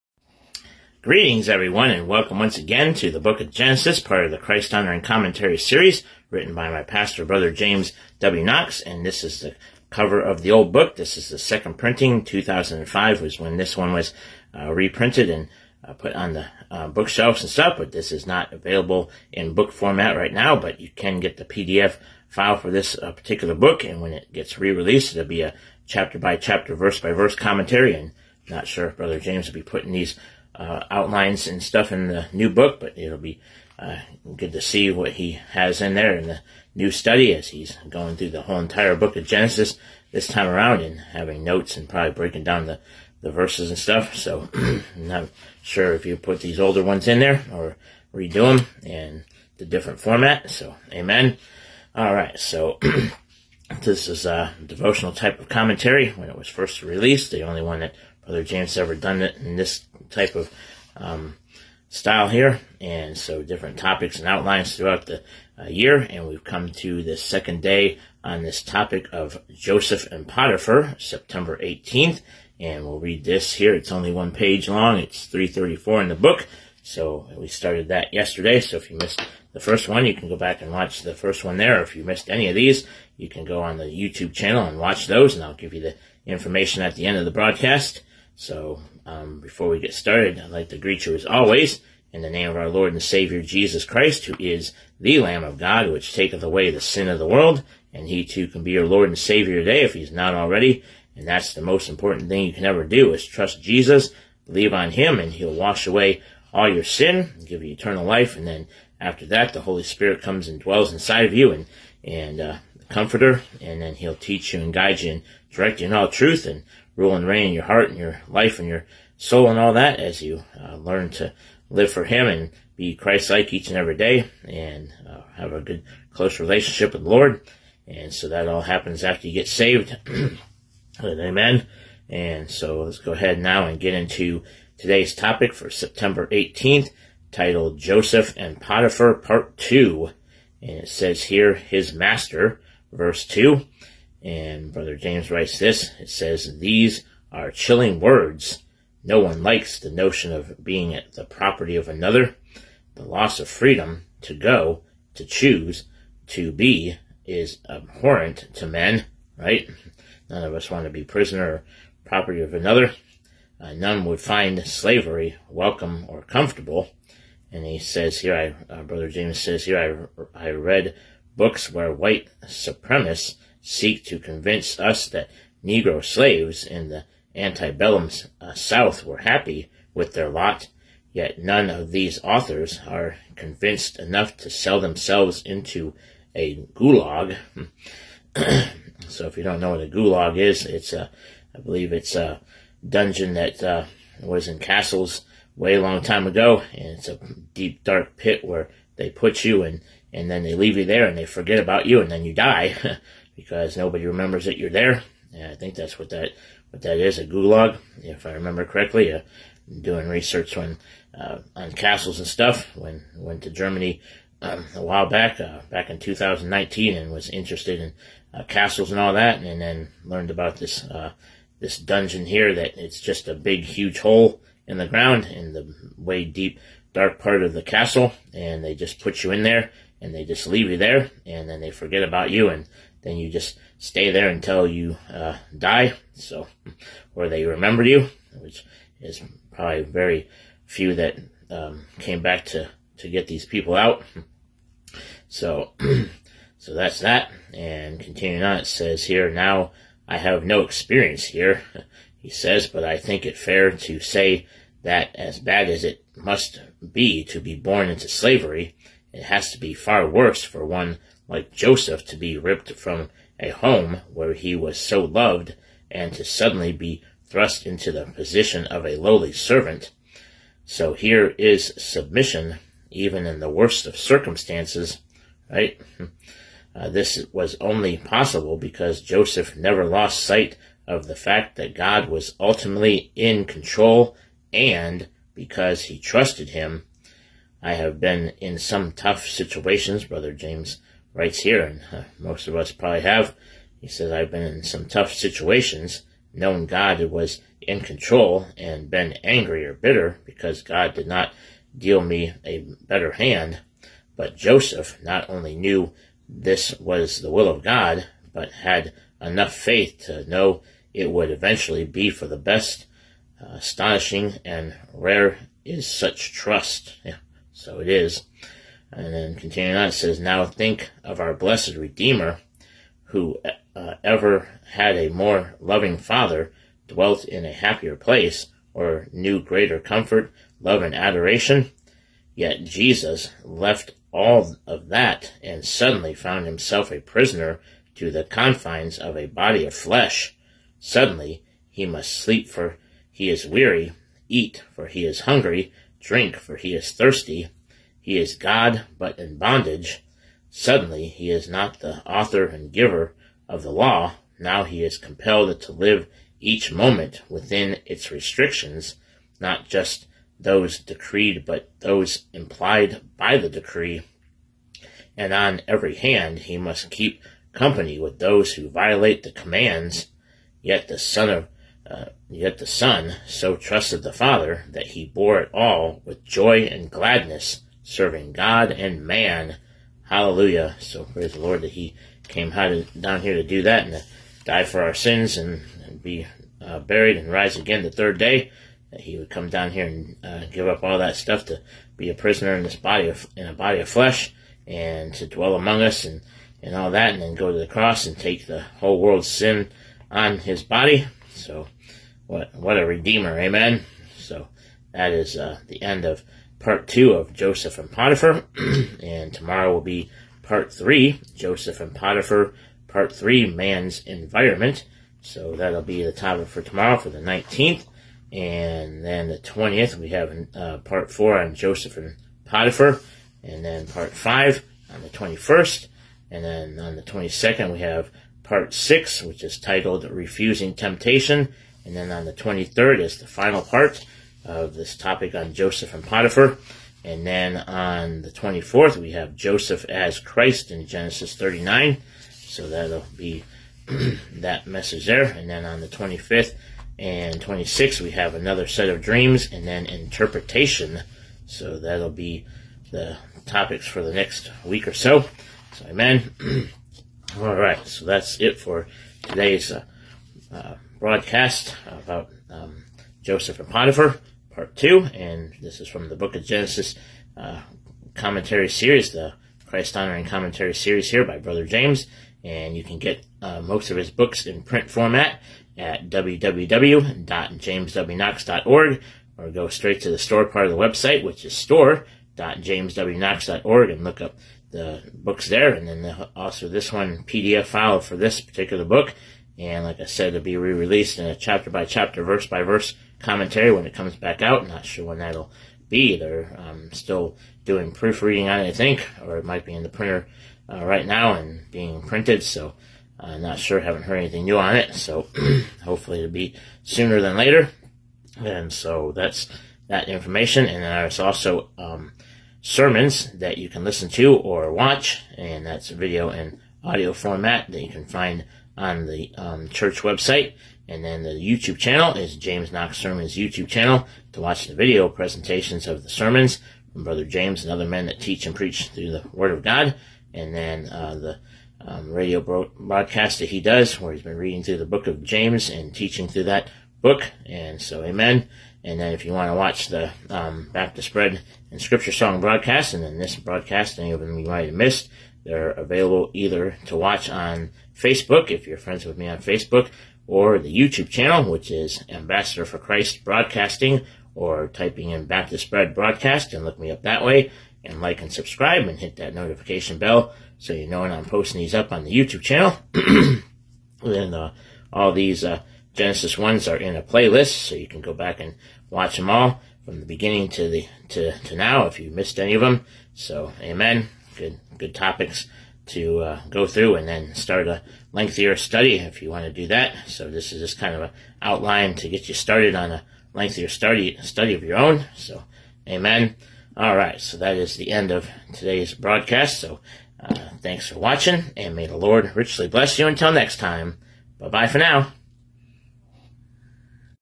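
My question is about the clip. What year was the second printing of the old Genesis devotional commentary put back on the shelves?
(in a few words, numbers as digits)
2005.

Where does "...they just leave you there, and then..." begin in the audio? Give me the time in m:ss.
3:50.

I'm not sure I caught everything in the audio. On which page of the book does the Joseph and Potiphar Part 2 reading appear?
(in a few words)
334.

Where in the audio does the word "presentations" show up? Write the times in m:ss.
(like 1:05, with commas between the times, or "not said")
8:45.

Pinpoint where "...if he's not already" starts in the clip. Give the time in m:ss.
1:39.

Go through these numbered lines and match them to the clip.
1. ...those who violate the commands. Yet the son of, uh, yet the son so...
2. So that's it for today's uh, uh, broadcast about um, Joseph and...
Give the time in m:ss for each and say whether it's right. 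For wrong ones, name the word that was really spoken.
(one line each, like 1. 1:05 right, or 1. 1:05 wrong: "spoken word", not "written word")
1. 6:08 right
2. 7:37 right.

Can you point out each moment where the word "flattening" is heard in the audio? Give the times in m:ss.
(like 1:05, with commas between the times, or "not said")
not said.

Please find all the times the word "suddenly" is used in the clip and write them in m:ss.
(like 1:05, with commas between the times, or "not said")
4:26, 5:35, 5:40, 5:50.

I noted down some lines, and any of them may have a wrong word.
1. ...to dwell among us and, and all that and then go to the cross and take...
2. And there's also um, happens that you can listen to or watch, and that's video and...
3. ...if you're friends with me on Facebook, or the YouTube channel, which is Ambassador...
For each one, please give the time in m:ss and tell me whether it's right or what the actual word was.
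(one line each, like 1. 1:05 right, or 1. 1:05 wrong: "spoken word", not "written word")
1. 6:35 right
2. 8:30 wrong: "sermons", not "happens"
3. 9:08 right.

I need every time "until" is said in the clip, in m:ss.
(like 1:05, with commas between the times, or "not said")
3:54, 9:53.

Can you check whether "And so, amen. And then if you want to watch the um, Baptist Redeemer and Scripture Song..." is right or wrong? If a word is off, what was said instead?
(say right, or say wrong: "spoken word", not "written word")
wrong: "Bread", not "Redeemer".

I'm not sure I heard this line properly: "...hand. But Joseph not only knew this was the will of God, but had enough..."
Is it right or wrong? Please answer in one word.
right.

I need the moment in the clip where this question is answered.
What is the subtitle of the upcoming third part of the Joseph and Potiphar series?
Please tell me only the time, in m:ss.
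6:53.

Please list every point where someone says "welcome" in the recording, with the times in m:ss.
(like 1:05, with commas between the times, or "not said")
0:02, 2:45.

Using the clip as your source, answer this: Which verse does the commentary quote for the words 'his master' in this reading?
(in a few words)
Verse 2.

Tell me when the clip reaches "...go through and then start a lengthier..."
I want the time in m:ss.
9:36.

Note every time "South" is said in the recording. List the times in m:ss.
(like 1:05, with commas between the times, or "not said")
2:58.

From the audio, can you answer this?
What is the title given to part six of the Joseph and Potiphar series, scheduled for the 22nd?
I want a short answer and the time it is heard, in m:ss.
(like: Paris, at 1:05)
Refusing Temptation, at 7:10.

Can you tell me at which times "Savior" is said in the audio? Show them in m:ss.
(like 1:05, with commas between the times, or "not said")
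1:33, 1:39.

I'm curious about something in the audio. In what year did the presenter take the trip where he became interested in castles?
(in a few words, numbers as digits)
2019.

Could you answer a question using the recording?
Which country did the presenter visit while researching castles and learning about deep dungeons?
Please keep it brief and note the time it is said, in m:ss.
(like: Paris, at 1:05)
Germany, at 3:33.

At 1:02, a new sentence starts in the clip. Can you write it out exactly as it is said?
And so different topics and outlines throughout the uh, year.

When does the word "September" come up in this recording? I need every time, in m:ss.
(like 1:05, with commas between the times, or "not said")
1:10, 2:15.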